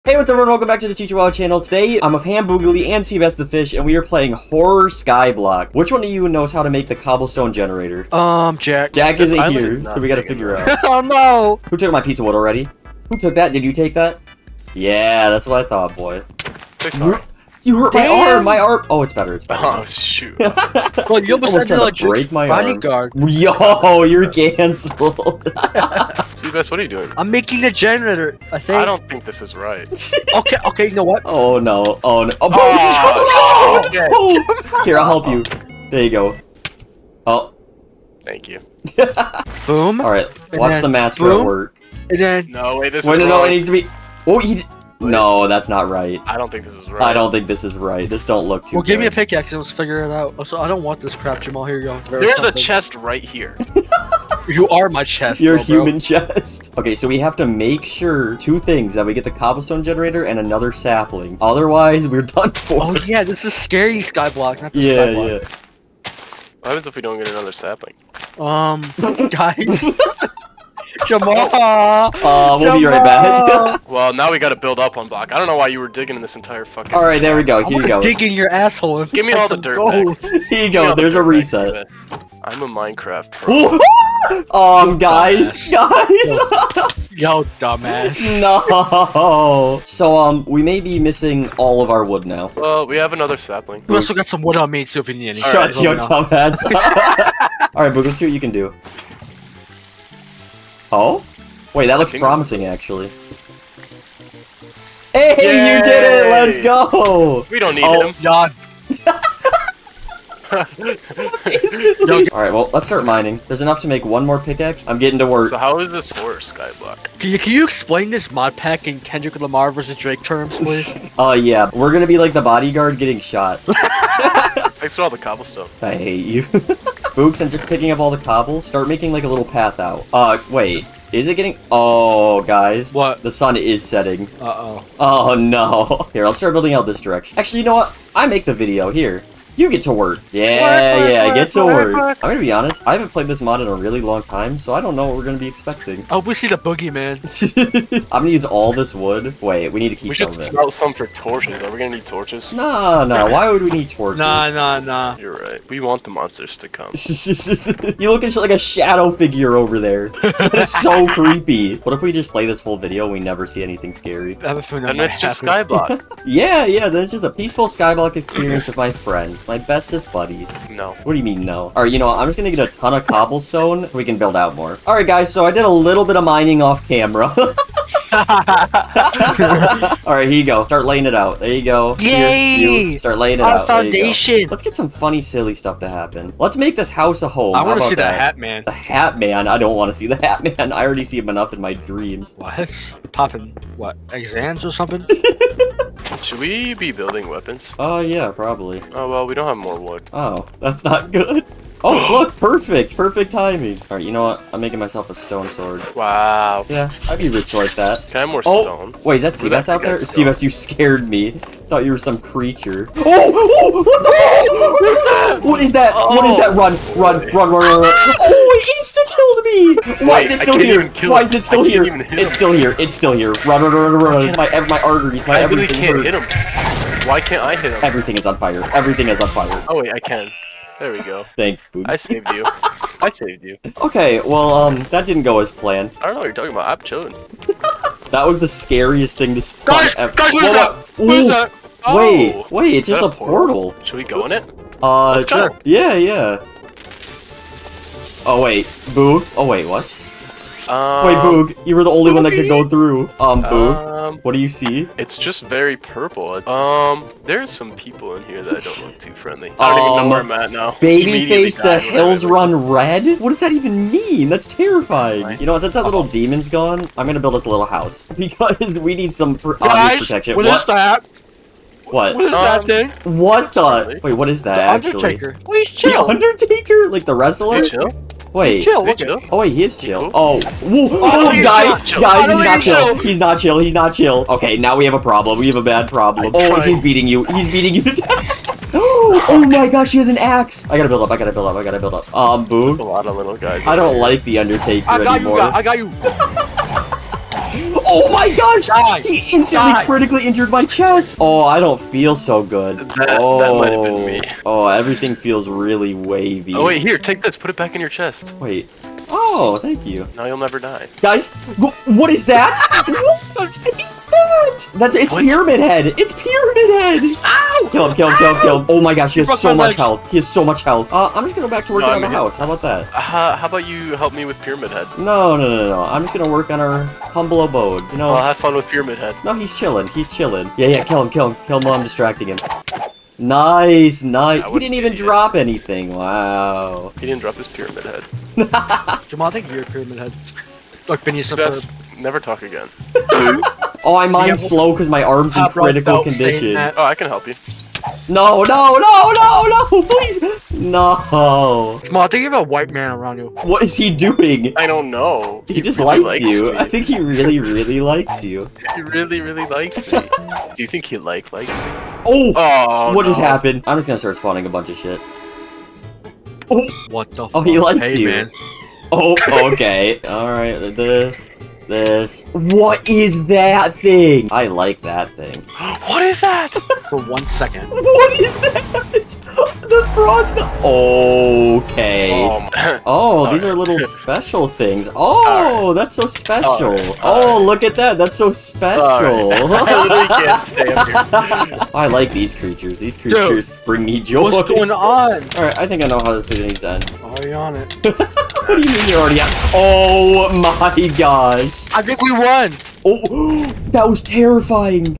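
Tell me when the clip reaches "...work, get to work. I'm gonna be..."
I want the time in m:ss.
2:21.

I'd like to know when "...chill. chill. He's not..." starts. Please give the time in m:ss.
4:42.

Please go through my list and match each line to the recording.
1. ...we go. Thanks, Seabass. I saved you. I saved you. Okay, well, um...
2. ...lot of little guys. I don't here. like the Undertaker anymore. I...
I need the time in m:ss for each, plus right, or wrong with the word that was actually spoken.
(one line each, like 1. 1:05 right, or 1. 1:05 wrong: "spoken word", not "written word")
1. 3:50 wrong: "Boots", not "Seabass"
2. 4:52 right.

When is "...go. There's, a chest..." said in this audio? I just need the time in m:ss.
0:51.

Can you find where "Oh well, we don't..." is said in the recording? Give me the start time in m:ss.
3:18.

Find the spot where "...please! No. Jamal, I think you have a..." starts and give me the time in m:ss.
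5:49.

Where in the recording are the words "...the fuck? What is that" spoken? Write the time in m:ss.
3:35.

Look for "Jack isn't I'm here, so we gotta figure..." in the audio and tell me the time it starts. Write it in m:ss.
0:08.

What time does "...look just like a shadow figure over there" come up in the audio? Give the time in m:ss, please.
2:38.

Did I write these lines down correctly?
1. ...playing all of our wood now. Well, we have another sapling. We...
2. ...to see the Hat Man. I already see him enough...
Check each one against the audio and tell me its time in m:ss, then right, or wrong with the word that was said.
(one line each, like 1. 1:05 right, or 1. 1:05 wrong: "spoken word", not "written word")
1. 1:30 wrong: "missing", not "playing"
2. 3:09 right.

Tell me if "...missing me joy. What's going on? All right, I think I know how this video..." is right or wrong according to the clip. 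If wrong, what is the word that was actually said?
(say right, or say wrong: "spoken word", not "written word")
wrong: "bring", not "missing".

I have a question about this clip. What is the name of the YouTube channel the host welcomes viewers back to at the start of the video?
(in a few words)
Teacher Wild.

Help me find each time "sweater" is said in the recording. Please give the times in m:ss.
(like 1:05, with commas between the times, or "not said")
not said.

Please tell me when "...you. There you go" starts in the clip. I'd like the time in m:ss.
0:35.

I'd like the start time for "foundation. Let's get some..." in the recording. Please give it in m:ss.
3:03.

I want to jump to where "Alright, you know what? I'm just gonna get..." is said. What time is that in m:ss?
2:51.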